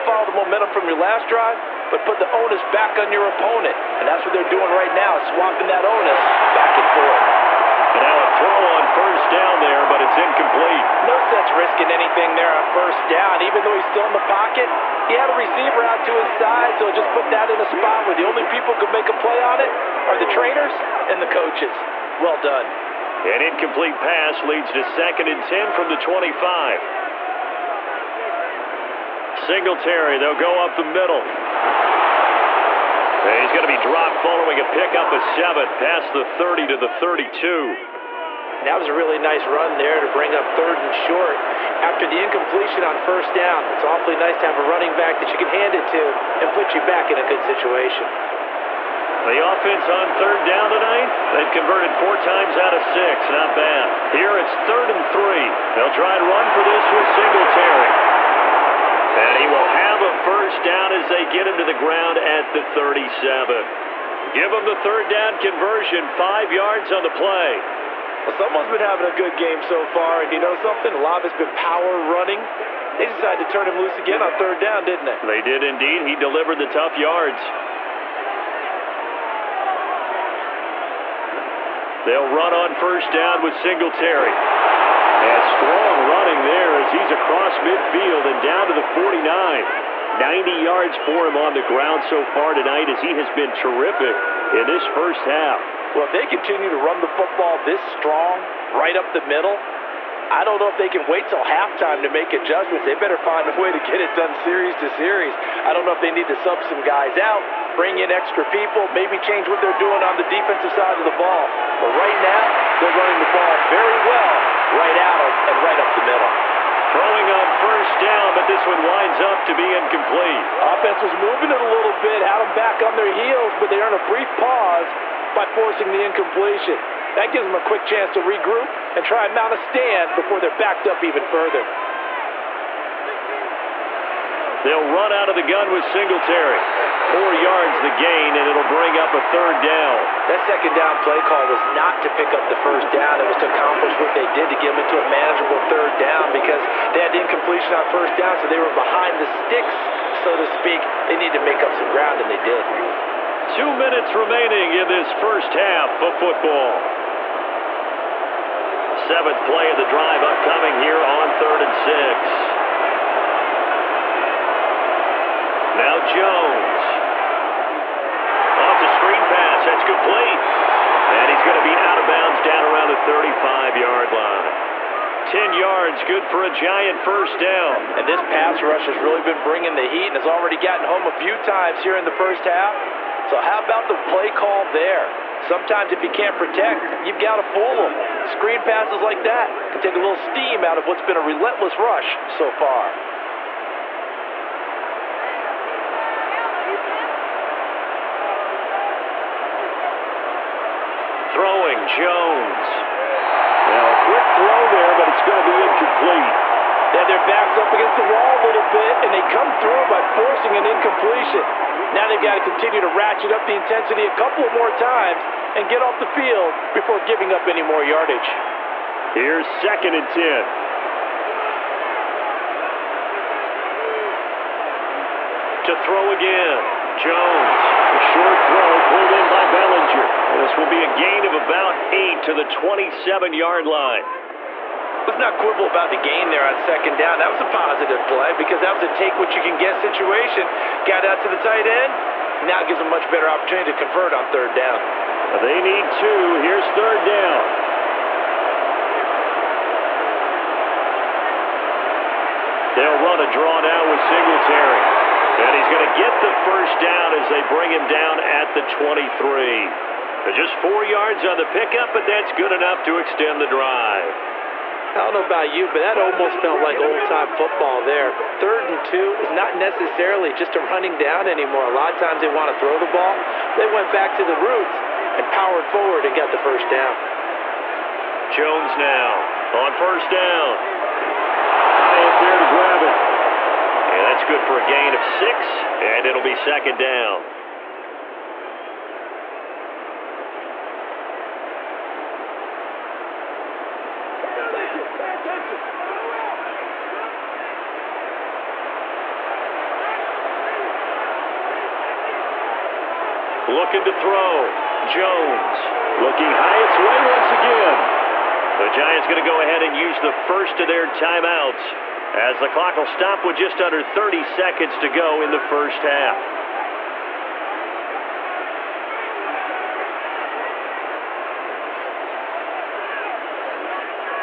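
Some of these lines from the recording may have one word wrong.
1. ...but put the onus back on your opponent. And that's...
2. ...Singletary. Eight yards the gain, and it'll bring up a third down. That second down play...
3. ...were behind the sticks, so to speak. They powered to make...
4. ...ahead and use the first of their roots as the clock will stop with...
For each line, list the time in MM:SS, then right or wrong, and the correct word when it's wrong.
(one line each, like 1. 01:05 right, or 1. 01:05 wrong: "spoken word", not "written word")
1. 00:01 right
2. 02:15 wrong: "Four", not "Eight"
3. 02:28 wrong: "needed", not "powered"
4. 05:09 wrong: "timeouts", not "roots".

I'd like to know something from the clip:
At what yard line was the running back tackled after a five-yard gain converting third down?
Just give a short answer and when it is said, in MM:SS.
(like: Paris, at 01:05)
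37, at 01:02.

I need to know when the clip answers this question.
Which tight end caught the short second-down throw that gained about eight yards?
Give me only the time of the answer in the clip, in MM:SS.
03:49.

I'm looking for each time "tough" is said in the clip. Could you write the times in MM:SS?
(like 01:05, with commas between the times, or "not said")
01:16.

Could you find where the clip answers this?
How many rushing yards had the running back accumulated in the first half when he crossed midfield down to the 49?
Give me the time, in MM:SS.
01:30.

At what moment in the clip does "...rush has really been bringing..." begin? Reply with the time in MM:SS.
02:58.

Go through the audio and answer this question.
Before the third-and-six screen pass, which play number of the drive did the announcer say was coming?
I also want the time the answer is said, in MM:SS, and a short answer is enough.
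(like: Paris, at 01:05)
Seventh, at 02:38.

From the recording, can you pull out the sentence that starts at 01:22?
They'll run on first down with Singletary.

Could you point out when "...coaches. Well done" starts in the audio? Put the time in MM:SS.
00:21.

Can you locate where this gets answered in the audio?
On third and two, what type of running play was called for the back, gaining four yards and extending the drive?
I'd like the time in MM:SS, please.
04:13.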